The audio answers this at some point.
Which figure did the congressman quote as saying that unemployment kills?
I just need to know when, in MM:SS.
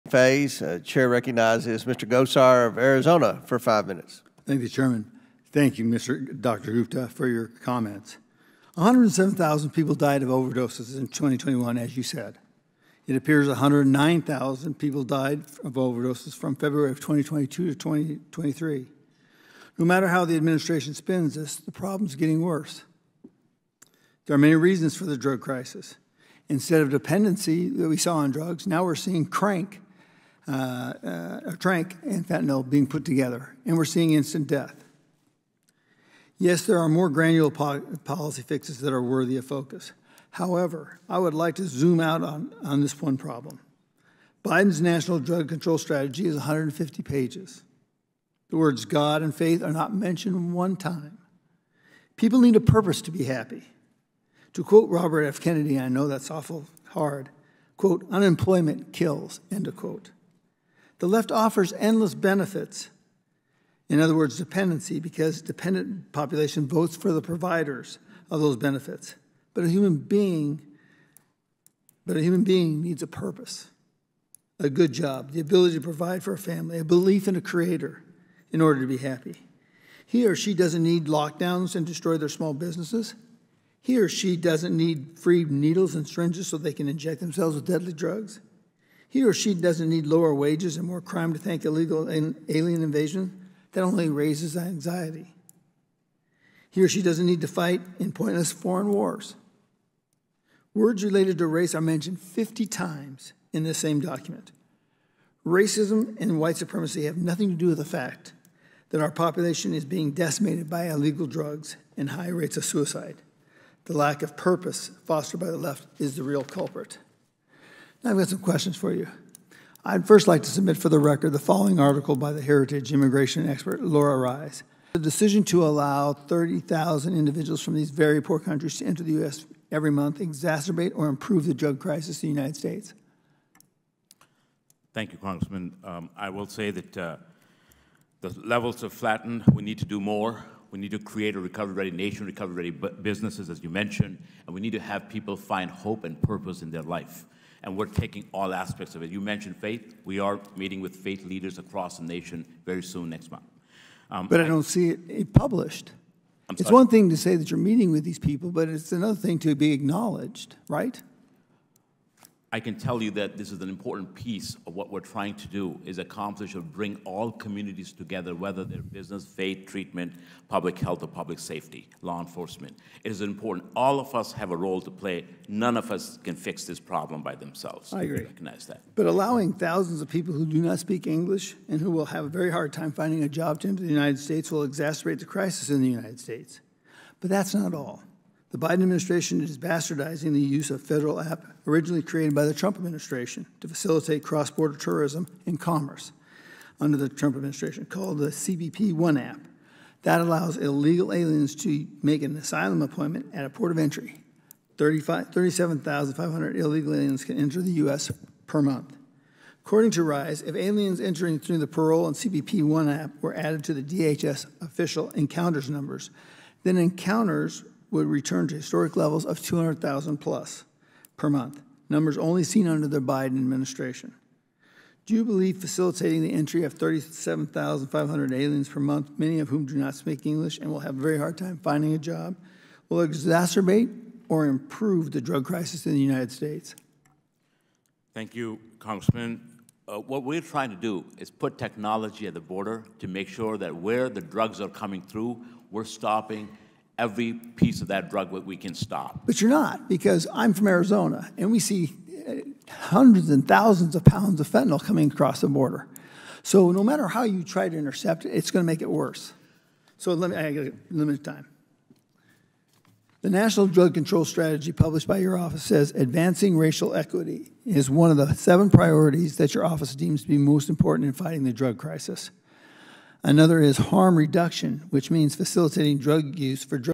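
00:54.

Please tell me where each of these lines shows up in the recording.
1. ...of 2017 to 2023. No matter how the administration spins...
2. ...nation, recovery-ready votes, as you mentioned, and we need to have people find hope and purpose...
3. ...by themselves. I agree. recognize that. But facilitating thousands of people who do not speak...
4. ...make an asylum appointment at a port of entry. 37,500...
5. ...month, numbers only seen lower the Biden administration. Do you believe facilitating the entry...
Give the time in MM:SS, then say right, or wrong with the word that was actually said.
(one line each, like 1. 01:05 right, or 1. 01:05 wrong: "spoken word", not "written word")
1. 00:16 wrong: "2022", not "2017"
2. 02:21 wrong: "businesses", not "votes"
3. 02:57 wrong: "allowing", not "facilitating"
4. 03:22 right
5. 03:41 wrong: "under", not "lower".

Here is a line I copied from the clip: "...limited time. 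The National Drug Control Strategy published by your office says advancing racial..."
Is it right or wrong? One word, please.
right.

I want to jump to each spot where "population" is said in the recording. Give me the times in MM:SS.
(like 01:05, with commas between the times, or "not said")
01:06, 01:49.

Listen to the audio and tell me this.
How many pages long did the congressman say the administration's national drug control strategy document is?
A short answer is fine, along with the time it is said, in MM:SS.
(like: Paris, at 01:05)
150, at 00:46.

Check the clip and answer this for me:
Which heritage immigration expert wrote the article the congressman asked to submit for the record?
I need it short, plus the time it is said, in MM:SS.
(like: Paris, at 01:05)
Lora Ries, at 02:03.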